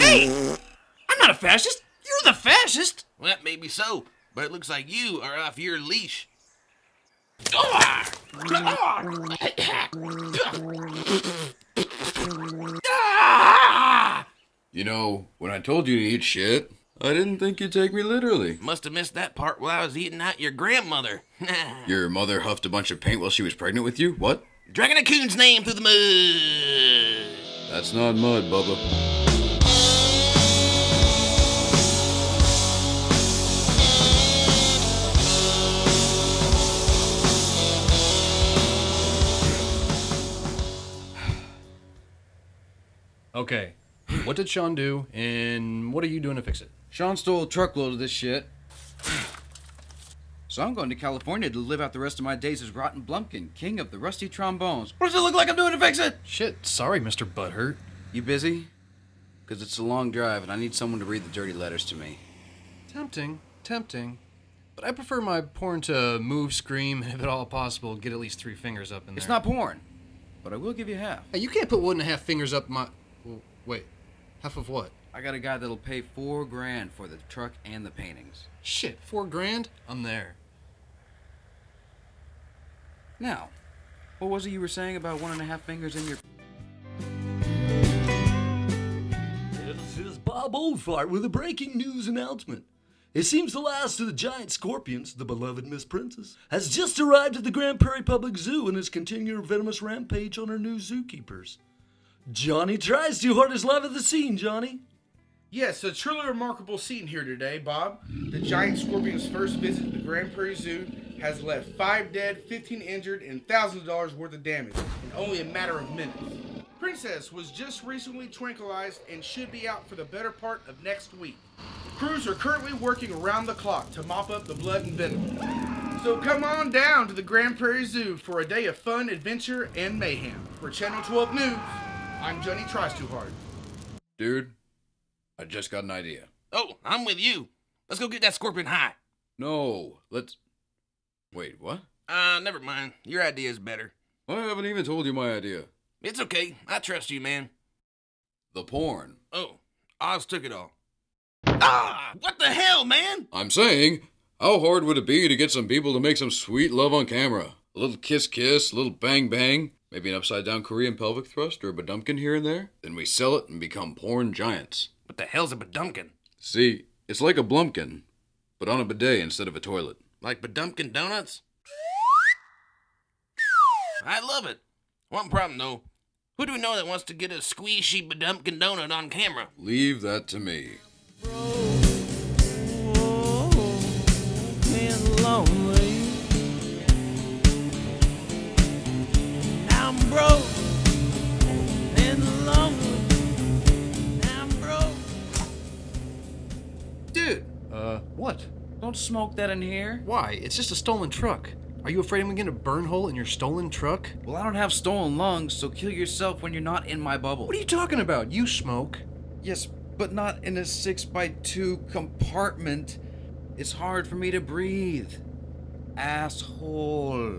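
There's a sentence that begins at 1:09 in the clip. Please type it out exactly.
It's not porn, but I will give you half.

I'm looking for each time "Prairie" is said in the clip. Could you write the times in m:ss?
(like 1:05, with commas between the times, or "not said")
1:37, 1:50, 2:07.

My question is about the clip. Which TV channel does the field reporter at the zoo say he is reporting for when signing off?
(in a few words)
Channel 12.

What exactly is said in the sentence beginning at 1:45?
Yes, a truly remarkable scene here today, Bob.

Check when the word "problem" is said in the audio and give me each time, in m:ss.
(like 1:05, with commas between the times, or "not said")
2:55.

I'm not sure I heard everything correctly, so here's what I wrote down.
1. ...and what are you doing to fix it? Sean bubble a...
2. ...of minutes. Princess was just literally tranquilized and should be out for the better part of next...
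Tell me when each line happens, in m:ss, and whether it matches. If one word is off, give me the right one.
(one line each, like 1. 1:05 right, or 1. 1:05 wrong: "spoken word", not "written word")
1. 0:45 wrong: "stole", not "bubble"
2. 1:55 wrong: "recently", not "literally".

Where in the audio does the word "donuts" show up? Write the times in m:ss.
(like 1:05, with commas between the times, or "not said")
2:50, 2:58.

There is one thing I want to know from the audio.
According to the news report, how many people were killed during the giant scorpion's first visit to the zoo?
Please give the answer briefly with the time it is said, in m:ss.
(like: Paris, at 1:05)
5, at 1:51.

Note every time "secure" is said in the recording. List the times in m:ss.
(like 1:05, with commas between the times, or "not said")
not said.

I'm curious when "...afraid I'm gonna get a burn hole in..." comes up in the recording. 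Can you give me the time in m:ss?
3:22.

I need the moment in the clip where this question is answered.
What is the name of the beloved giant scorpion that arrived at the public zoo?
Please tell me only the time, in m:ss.
1:35.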